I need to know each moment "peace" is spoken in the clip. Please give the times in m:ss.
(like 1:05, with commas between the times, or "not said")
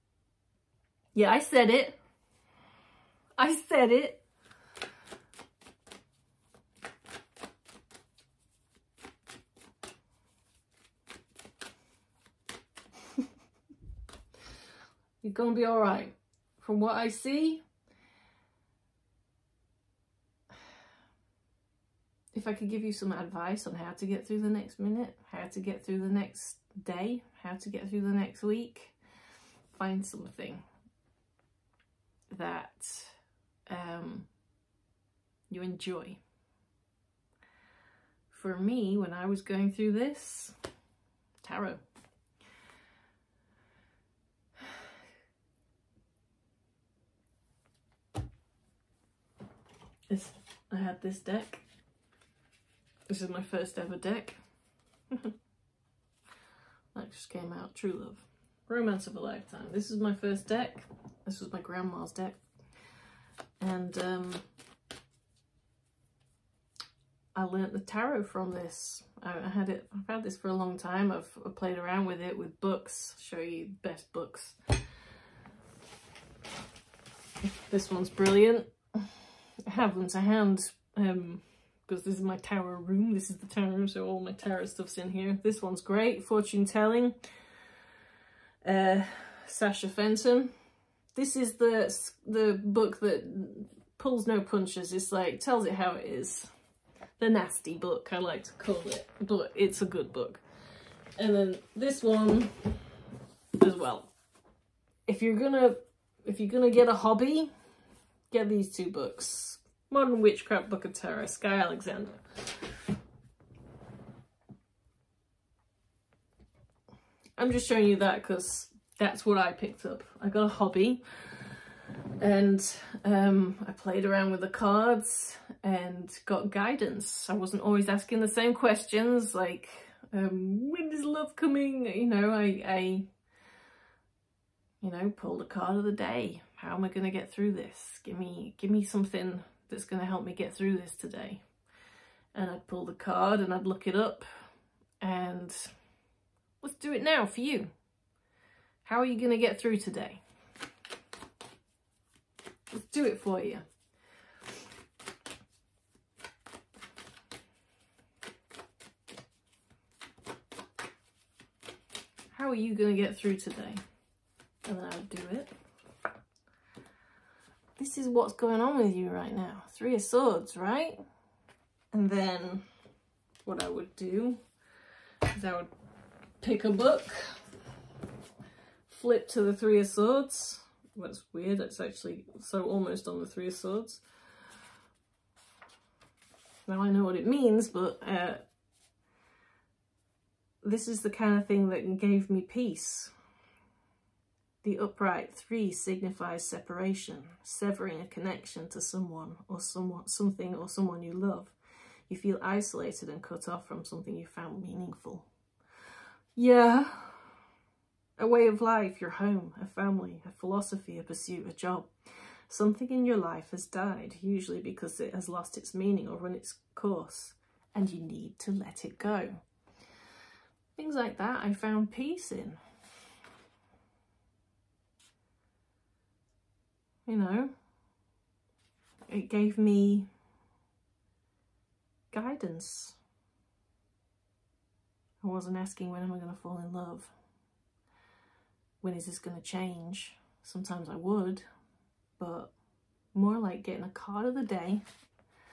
3:12, 3:41.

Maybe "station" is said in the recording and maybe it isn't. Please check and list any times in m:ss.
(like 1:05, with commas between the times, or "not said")
not said.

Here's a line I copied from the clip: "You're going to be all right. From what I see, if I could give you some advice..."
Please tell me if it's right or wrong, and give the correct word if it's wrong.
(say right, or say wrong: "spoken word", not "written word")
right.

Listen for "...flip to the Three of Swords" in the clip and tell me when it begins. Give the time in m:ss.
2:58.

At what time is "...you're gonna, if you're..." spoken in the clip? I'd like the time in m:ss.
1:45.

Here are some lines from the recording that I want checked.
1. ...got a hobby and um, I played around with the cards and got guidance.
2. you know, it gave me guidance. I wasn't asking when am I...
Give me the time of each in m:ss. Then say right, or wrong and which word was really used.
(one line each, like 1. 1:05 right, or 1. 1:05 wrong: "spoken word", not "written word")
1. 2:00 right
2. 3:47 right.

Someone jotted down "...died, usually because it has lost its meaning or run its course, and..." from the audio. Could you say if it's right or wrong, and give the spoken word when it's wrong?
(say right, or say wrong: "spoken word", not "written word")
right.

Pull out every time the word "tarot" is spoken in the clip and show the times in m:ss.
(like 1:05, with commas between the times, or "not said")
0:41, 1:07, 1:24, 1:50.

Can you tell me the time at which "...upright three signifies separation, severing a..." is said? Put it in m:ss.
3:14.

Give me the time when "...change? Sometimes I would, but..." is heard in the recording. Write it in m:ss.
3:59.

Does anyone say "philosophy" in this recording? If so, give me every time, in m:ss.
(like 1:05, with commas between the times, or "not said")
3:30.